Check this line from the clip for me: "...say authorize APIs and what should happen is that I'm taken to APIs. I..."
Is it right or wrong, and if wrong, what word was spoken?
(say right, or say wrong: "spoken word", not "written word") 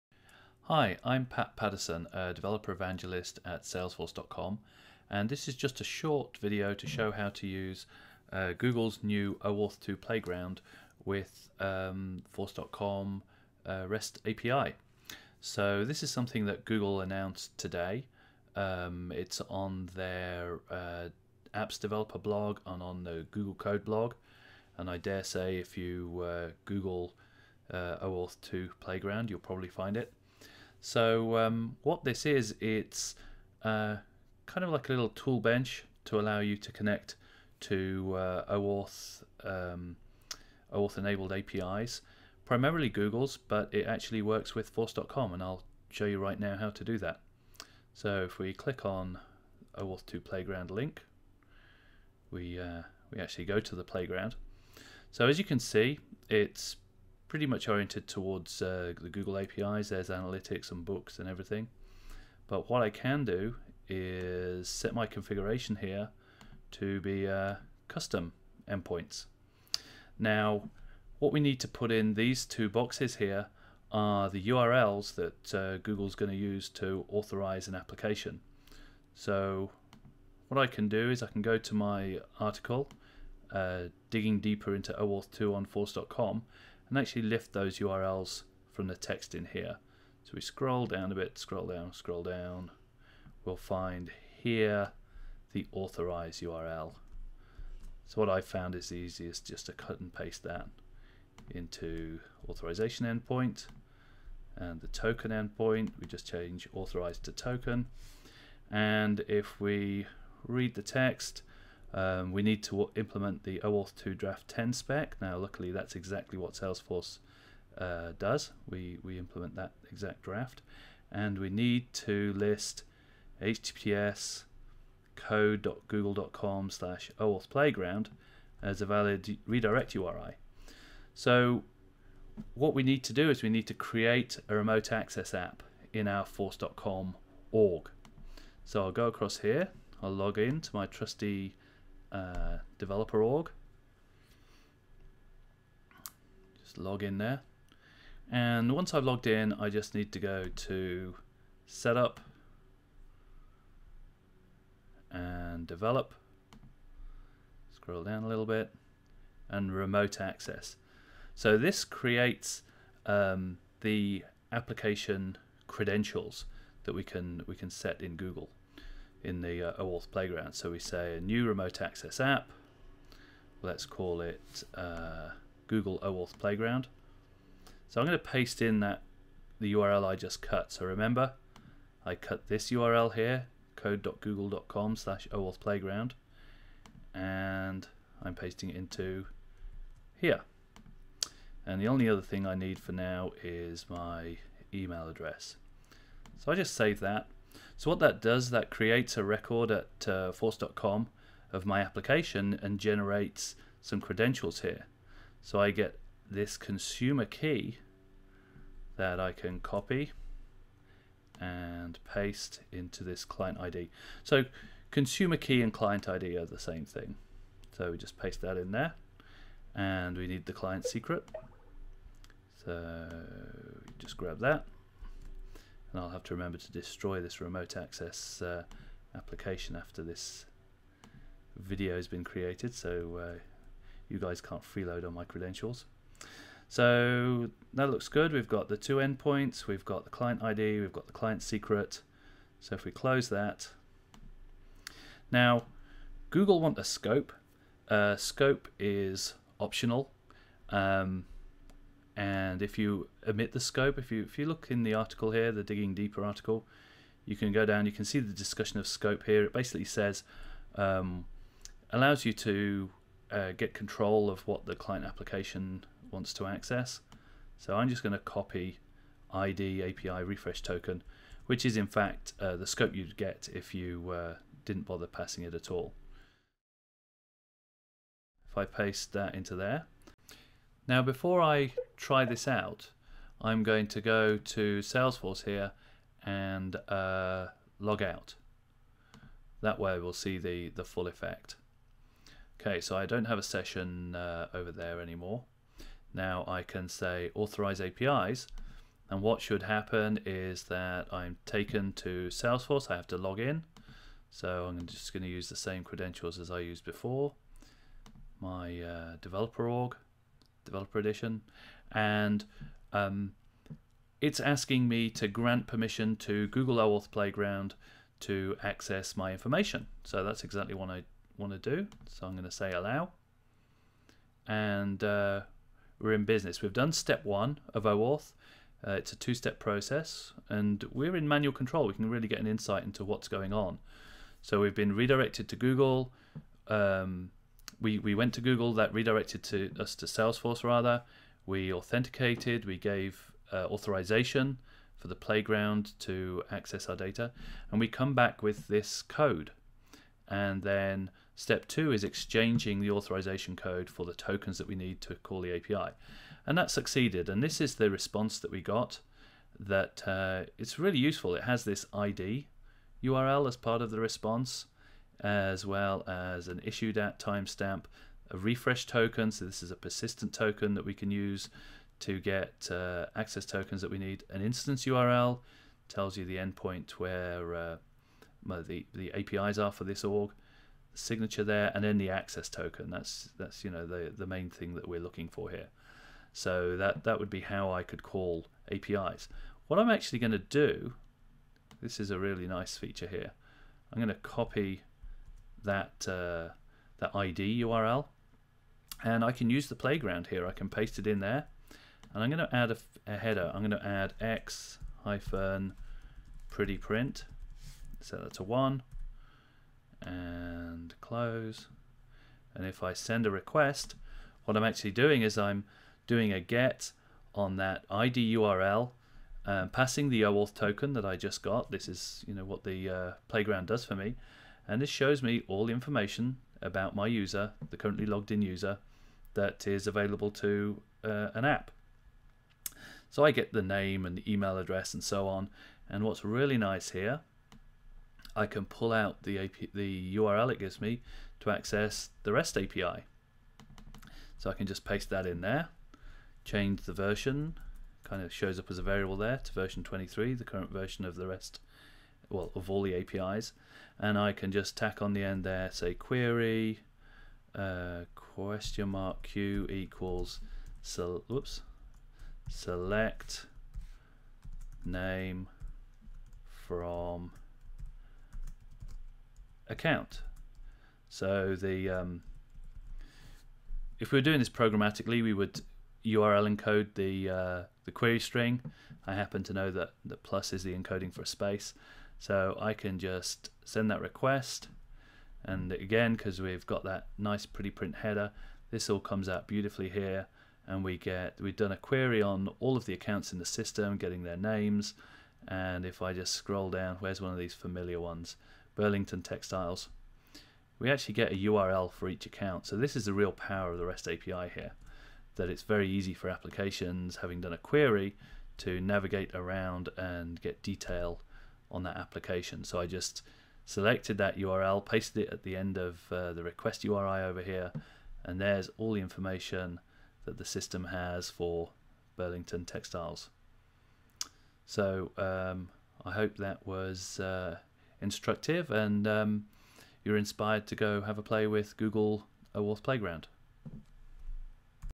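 wrong: "Salesforce", not "APIs".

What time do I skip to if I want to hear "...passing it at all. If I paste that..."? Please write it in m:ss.
4:35.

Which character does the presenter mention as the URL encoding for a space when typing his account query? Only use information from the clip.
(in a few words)
plus.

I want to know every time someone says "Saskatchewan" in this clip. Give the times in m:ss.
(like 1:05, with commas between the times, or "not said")
not said.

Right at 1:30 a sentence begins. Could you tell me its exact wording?
So we scroll down a bit, scroll down, scroll down.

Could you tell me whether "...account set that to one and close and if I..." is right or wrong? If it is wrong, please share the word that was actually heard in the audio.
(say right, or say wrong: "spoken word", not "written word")
wrong: "print", not "account".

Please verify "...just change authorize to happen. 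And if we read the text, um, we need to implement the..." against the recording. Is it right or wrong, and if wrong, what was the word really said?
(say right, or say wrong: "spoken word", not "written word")
wrong: "token", not "happen".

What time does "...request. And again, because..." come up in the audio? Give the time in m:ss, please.
8:03.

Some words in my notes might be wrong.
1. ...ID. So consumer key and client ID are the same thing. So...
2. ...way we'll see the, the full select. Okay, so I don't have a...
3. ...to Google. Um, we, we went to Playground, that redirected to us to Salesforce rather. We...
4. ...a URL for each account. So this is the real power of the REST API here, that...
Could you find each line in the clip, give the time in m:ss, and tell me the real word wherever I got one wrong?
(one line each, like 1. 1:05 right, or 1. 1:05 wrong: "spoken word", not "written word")
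1. 3:33 right
2. 4:49 wrong: "effect", not "select"
3. 5:35 wrong: "Google", not "Playground"
4. 8:21 right.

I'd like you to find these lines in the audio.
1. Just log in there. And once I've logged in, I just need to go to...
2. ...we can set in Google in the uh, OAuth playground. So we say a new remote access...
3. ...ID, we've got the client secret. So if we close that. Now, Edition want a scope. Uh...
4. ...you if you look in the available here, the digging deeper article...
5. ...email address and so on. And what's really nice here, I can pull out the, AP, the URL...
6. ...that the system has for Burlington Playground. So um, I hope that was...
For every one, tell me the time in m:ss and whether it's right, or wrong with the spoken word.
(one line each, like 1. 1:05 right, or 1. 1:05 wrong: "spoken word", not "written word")
1. 2:26 right
2. 2:47 right
3. 4:00 wrong: "Google", not "Edition"
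4. 4:14 wrong: "article", not "available"
5. 7:14 right
6. 8:40 wrong: "Textiles", not "Playground".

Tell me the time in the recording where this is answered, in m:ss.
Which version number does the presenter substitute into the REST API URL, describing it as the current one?
7:29.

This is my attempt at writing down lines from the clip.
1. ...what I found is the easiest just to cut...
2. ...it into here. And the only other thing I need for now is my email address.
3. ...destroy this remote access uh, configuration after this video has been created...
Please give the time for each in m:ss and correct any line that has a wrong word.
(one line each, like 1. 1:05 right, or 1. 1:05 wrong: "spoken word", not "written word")
1. 1:38 right
2. 3:08 right
3. 3:46 wrong: "application", not "configuration".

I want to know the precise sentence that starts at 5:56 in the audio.
And that succeeded, and this is the response that we got that uh, it's really useful.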